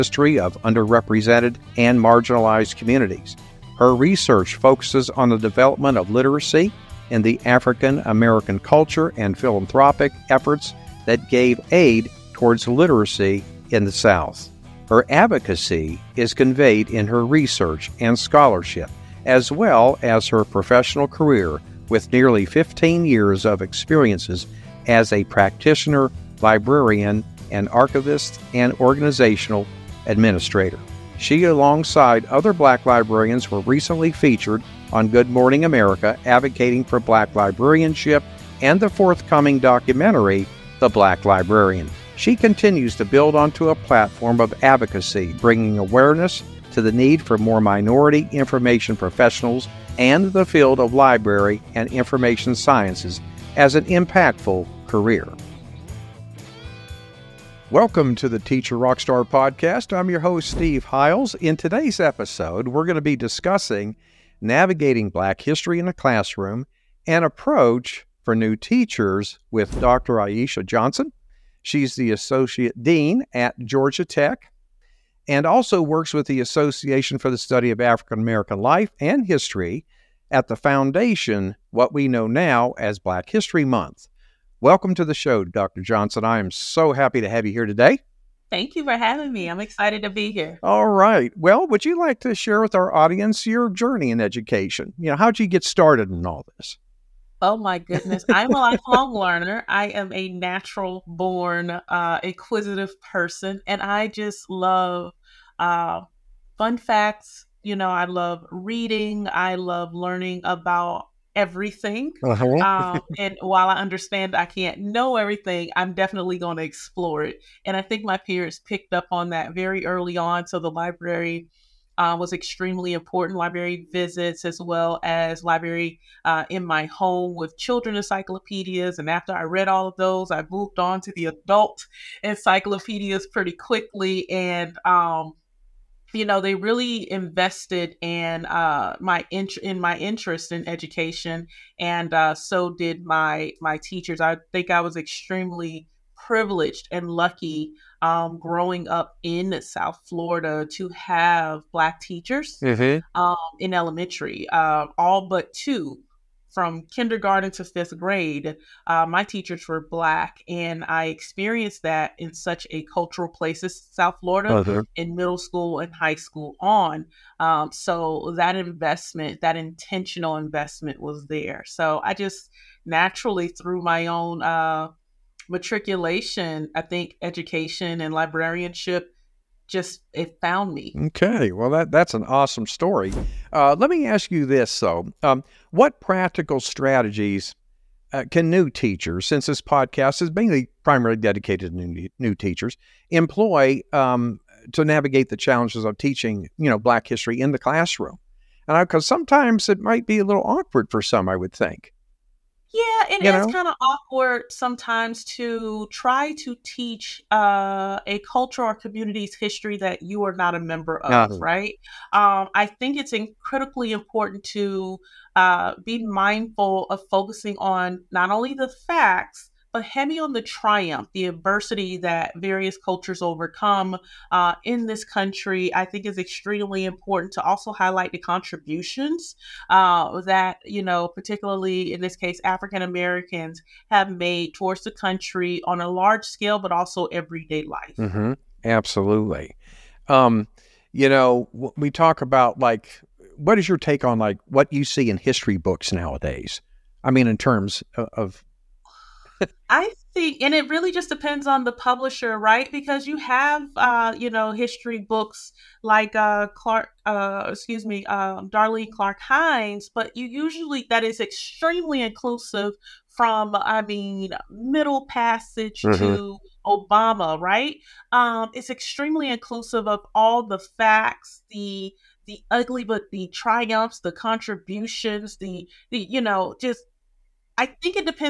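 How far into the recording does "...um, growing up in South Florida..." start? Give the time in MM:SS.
02:28.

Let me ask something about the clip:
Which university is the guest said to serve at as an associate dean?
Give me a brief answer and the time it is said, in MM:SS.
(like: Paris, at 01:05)
Georgia Tech, at 01:13.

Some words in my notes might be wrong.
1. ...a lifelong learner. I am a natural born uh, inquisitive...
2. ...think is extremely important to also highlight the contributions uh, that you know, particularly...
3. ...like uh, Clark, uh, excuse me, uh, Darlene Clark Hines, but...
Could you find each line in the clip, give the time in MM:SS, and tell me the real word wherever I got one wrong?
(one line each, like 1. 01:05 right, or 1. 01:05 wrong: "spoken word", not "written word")
1. 01:38 right
2. 03:45 right
3. 04:15 right.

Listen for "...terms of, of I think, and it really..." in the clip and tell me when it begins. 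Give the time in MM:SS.
04:07.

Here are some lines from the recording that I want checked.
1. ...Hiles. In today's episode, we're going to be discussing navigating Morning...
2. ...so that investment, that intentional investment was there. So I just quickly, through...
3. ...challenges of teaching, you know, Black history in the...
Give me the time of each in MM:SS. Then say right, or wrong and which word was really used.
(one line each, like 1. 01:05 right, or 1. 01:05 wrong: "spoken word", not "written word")
1. 01:00 wrong: "Black", not "Morning"
2. 02:47 wrong: "naturally", not "quickly"
3. 03:15 right.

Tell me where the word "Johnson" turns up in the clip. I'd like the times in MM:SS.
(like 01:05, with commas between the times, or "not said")
01:10, 01:25.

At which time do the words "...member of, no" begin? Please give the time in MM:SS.
03:30.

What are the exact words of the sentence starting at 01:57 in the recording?
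And I think my peers picked up on that very early on.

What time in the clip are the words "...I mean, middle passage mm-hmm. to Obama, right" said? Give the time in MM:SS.
04:23.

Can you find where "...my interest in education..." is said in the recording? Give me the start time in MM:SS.
02:19.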